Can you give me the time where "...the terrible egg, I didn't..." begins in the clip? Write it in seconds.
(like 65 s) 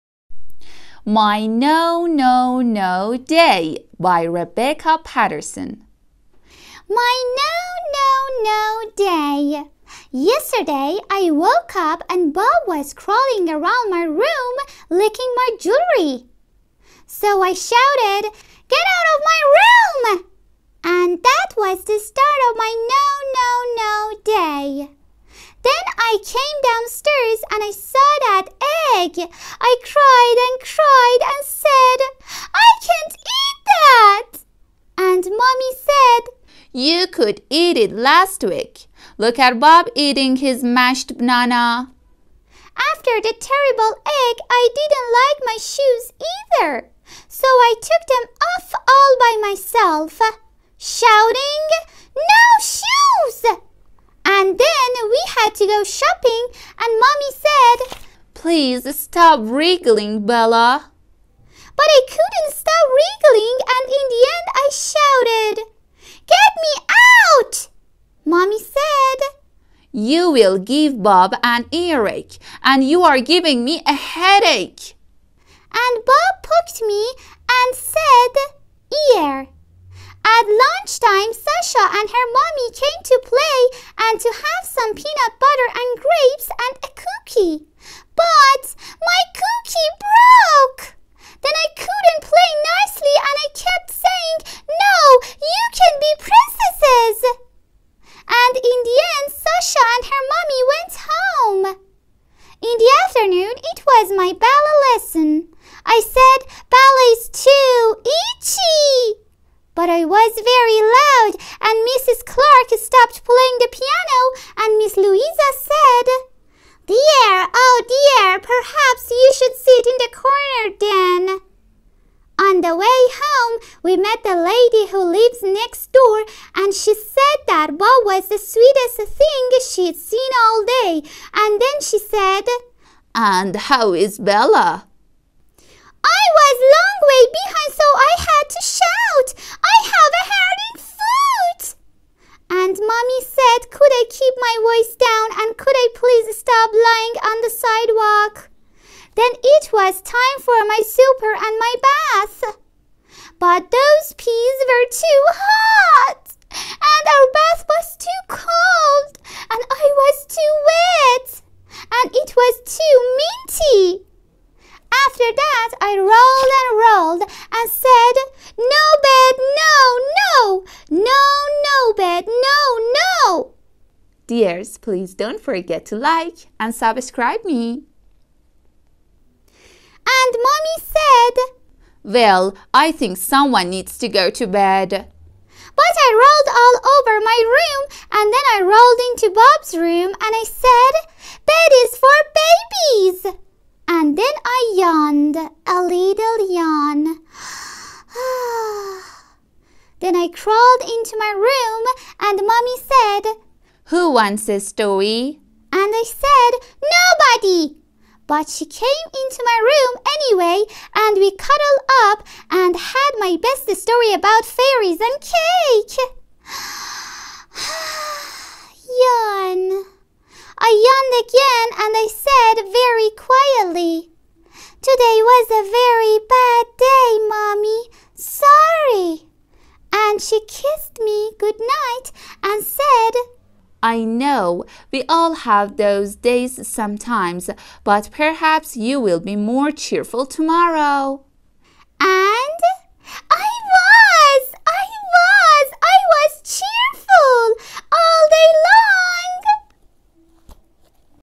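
43 s.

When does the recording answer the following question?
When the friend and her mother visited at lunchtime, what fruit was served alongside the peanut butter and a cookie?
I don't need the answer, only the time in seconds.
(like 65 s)
86 s.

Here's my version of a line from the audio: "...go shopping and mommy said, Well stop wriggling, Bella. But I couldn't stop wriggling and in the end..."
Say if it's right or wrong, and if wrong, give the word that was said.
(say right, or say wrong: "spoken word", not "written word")
wrong: "Please", not "Well".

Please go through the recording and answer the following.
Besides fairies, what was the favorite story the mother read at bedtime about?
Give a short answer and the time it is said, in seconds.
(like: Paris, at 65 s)
cake, at 215 s.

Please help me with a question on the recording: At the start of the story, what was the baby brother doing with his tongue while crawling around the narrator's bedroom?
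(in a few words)
licking my jewelry.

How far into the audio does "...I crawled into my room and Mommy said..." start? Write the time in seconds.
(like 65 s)
200 s.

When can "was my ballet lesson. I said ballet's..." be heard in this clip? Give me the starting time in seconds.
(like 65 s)
104 s.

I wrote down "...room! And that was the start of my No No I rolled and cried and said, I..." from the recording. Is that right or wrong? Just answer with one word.
wrong.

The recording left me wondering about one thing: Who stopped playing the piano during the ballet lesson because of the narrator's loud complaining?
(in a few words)
Mrs. Clark.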